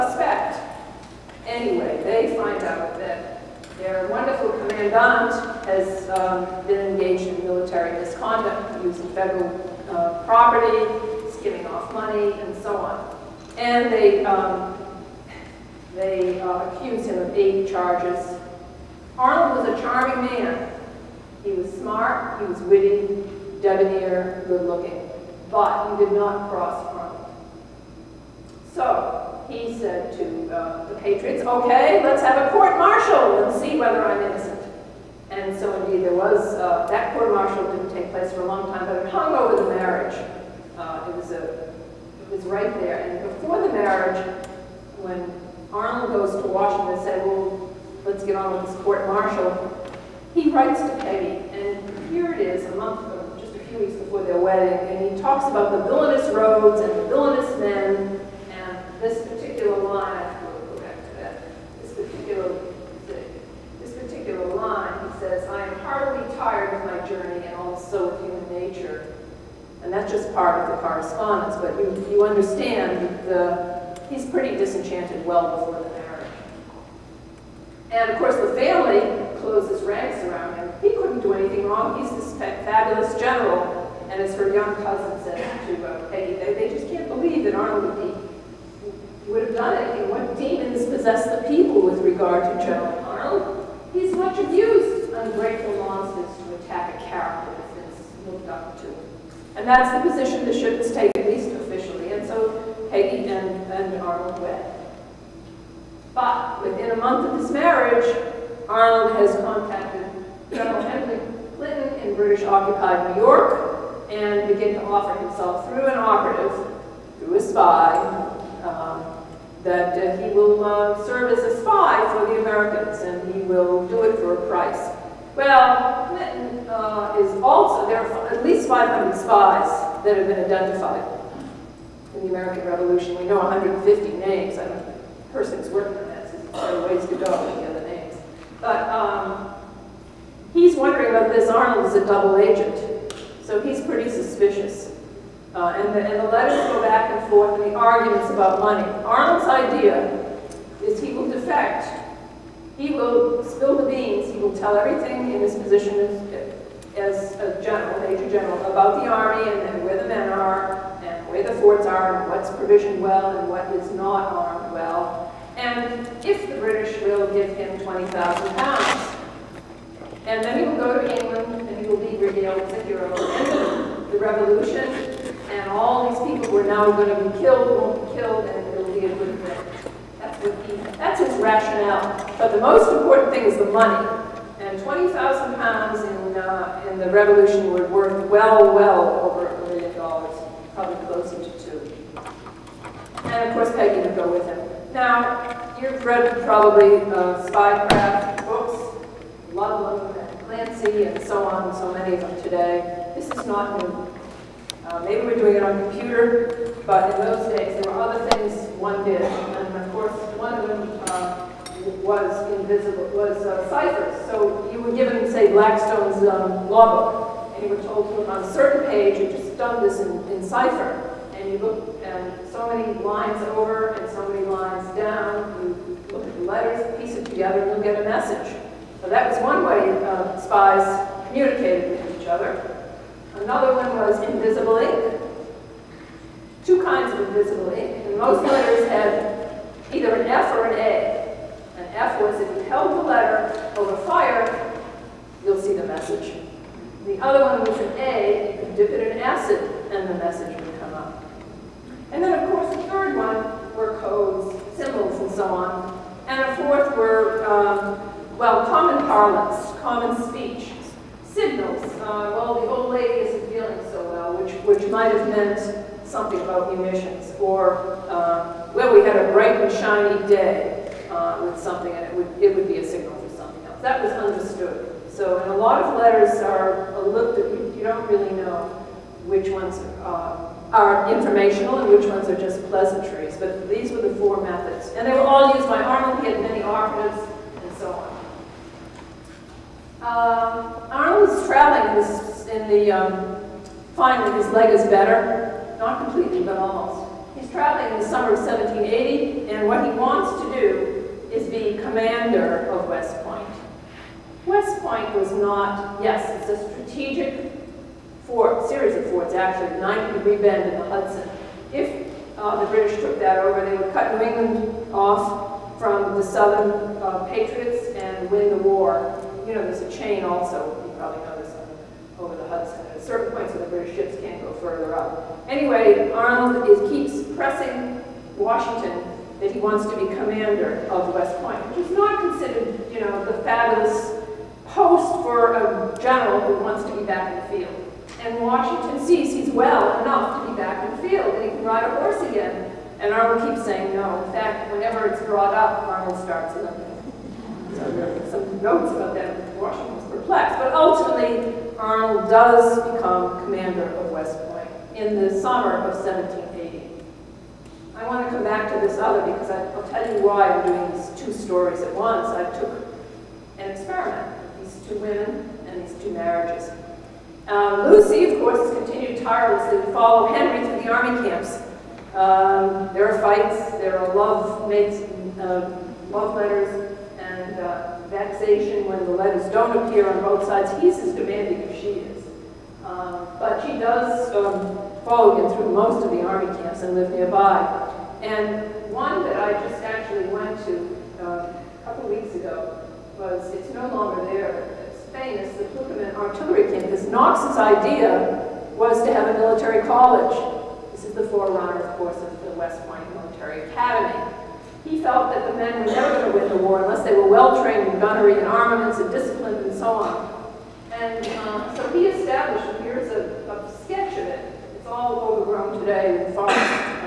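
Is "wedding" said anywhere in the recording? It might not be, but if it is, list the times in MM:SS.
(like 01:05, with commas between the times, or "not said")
00:54.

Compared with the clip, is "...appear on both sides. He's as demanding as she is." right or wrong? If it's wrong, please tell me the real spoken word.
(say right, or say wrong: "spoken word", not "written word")
right.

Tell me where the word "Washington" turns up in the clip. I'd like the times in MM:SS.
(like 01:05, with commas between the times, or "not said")
00:46, 05:28, 05:38, 05:49.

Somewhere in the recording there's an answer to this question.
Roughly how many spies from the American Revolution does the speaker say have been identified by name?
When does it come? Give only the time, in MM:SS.
02:13.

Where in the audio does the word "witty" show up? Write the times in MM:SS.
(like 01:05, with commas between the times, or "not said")
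00:22.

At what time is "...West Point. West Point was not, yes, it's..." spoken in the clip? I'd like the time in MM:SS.
05:02.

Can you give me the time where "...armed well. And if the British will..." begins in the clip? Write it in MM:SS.
02:44.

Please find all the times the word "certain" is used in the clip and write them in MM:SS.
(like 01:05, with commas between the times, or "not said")
03:38, 05:23.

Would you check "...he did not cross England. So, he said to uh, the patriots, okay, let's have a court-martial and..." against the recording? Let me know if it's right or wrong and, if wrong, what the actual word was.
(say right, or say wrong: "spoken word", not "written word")
wrong: "Arnold", not "England".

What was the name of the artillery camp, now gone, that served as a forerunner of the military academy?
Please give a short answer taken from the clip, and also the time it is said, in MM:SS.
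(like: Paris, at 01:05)
Pluckemin, at 06:35.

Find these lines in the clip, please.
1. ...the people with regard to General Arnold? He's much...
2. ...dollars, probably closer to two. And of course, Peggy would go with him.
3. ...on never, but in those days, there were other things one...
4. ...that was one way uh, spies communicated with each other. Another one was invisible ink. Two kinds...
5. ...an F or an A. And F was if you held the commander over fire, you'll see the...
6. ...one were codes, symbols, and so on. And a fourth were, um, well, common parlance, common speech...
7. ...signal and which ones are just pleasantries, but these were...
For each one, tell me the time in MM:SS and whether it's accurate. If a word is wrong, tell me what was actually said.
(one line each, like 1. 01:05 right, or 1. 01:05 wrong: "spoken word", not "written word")
1. 01:31 right
2. 03:09 right
3. 03:25 wrong: "computer", not "never"
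4. 03:49 right
5. 04:00 wrong: "letter", not "commander"
6. 04:13 right
7. 04:41 wrong: "informational", not "signal".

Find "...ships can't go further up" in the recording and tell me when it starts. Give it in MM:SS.
05:23.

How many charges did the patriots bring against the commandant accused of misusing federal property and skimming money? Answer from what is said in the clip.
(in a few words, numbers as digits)
8.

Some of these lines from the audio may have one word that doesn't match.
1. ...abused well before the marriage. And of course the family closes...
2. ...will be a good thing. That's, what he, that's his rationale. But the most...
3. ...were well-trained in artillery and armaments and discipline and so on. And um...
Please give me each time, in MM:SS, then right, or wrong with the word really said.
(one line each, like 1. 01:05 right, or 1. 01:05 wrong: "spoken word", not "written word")
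1. 01:14 wrong: "disenchanted", not "abused"
2. 02:58 right
3. 06:47 wrong: "gunnery", not "artillery".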